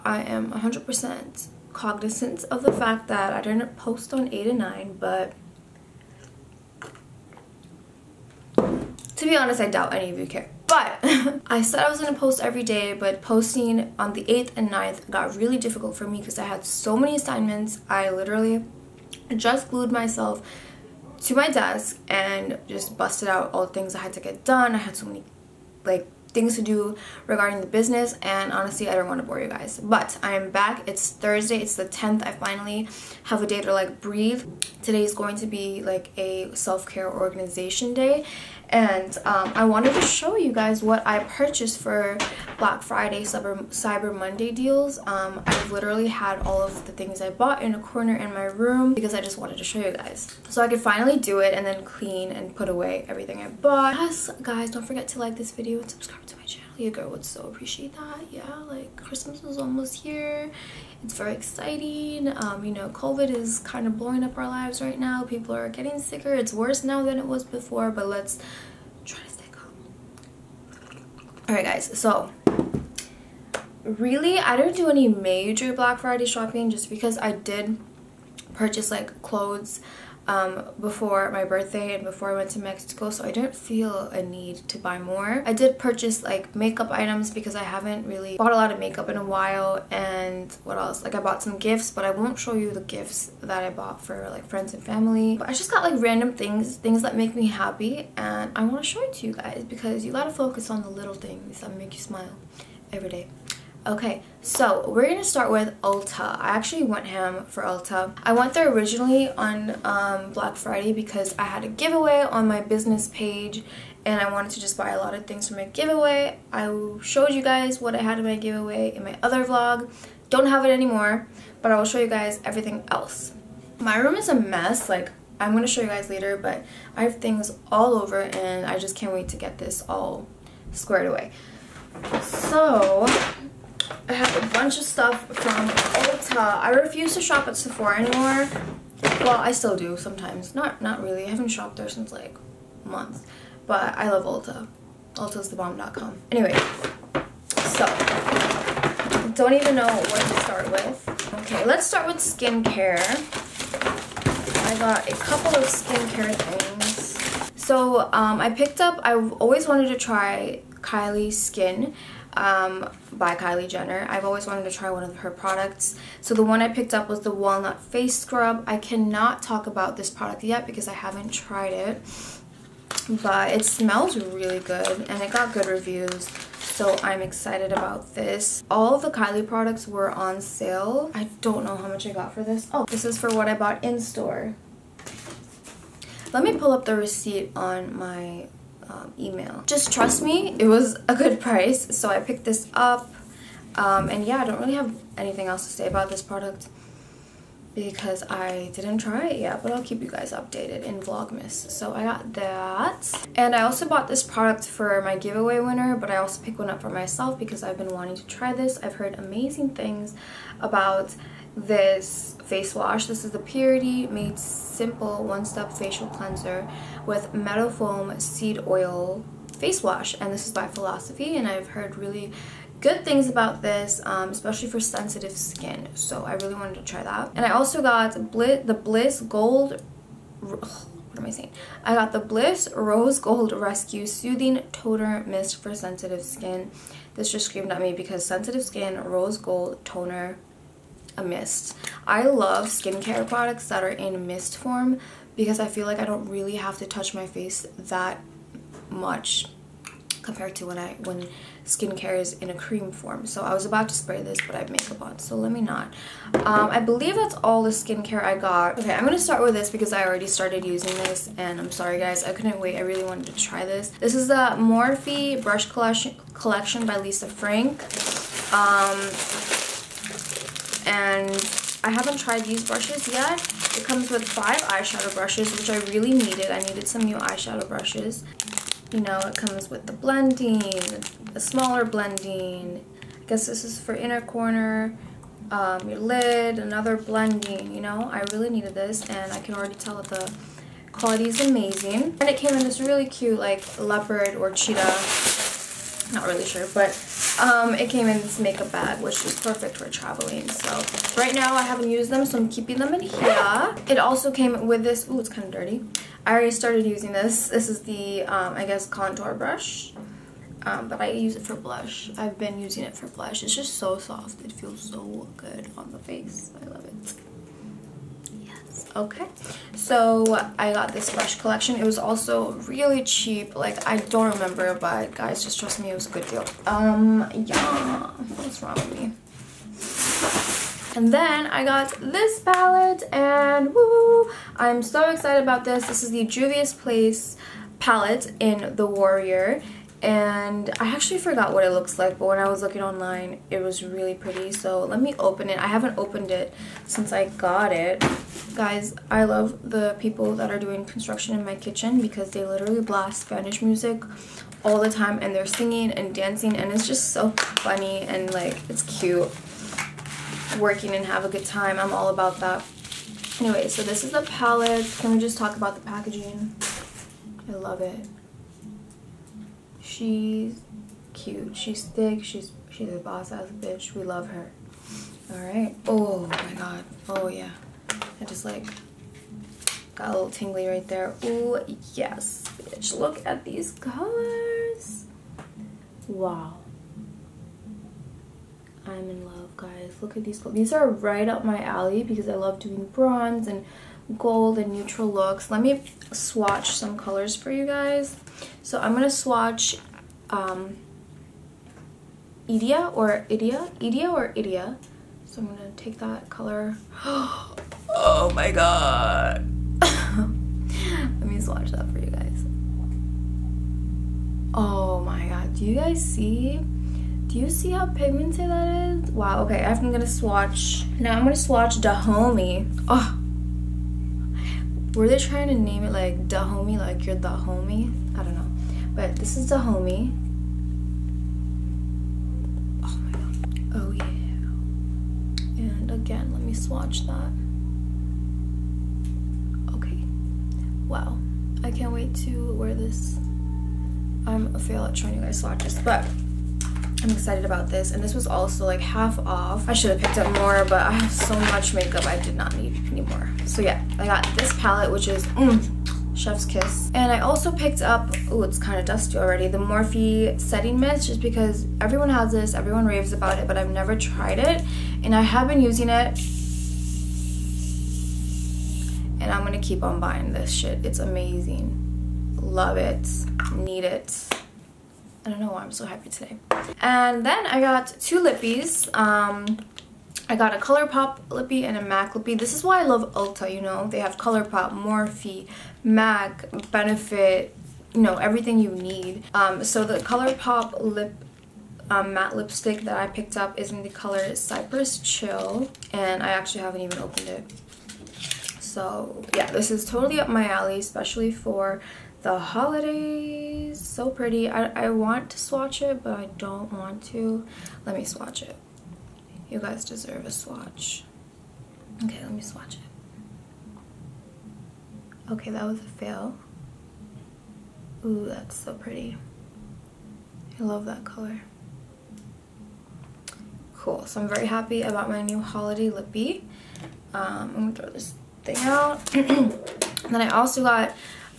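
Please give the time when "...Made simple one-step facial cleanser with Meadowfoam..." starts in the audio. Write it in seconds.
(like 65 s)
214 s.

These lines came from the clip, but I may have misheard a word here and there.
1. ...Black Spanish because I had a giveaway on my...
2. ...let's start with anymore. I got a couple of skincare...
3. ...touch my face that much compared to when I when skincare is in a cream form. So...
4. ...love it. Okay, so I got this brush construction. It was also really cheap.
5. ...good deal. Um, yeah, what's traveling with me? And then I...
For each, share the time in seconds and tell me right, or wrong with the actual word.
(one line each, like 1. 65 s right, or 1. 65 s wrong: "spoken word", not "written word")
1. 110 s wrong: "Friday", not "Spanish"
2. 151 s wrong: "skincare", not "anymore"
3. 246 s right
4. 316 s wrong: "collection", not "construction"
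5. 326 s wrong: "wrong", not "traveling".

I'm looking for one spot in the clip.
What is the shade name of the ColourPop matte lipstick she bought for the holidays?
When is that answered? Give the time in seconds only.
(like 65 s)
494 s.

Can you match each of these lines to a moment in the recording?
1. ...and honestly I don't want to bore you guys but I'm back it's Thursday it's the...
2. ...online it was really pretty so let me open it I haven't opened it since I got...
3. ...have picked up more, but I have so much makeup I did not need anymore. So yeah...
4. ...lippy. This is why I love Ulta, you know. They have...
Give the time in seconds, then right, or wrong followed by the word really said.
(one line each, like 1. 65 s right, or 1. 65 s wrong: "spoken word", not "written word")
1. 28 s right
2. 342 s right
3. 449 s right
4. 482 s right.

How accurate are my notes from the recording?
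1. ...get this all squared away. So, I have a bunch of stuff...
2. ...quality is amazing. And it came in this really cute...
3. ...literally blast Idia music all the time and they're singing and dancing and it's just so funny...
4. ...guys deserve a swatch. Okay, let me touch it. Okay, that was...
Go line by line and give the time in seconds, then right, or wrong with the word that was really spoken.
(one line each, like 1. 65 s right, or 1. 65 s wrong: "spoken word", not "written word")
1. 129 s right
2. 290 s right
3. 352 s wrong: "Spanish", not "Idia"
4. 509 s wrong: "swatch", not "touch".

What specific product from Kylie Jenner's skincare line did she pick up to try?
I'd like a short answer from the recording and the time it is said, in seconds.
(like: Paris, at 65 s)
Walnut Face Scrub, at 167 s.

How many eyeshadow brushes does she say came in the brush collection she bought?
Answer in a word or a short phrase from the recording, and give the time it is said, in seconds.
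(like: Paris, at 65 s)
5, at 274 s.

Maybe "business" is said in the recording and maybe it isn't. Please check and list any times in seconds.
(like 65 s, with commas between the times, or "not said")
27 s, 112 s.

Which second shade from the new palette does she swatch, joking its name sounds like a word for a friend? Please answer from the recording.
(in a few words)
Dahomey.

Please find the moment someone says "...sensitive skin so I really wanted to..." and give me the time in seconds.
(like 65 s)
224 s.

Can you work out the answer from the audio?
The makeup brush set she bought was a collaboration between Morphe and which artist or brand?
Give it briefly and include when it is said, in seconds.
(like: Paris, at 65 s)
Lisa Frank, at 266 s.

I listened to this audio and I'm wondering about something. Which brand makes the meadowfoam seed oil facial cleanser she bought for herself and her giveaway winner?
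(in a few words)
Philosophy.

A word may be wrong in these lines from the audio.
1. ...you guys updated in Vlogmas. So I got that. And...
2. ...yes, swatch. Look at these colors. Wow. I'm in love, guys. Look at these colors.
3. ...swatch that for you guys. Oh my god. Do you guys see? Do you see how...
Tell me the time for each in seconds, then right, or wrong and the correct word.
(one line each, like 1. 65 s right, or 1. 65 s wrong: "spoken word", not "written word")
1. 200 s right
2. 381 s wrong: "bitch", not "swatch"
3. 411 s right.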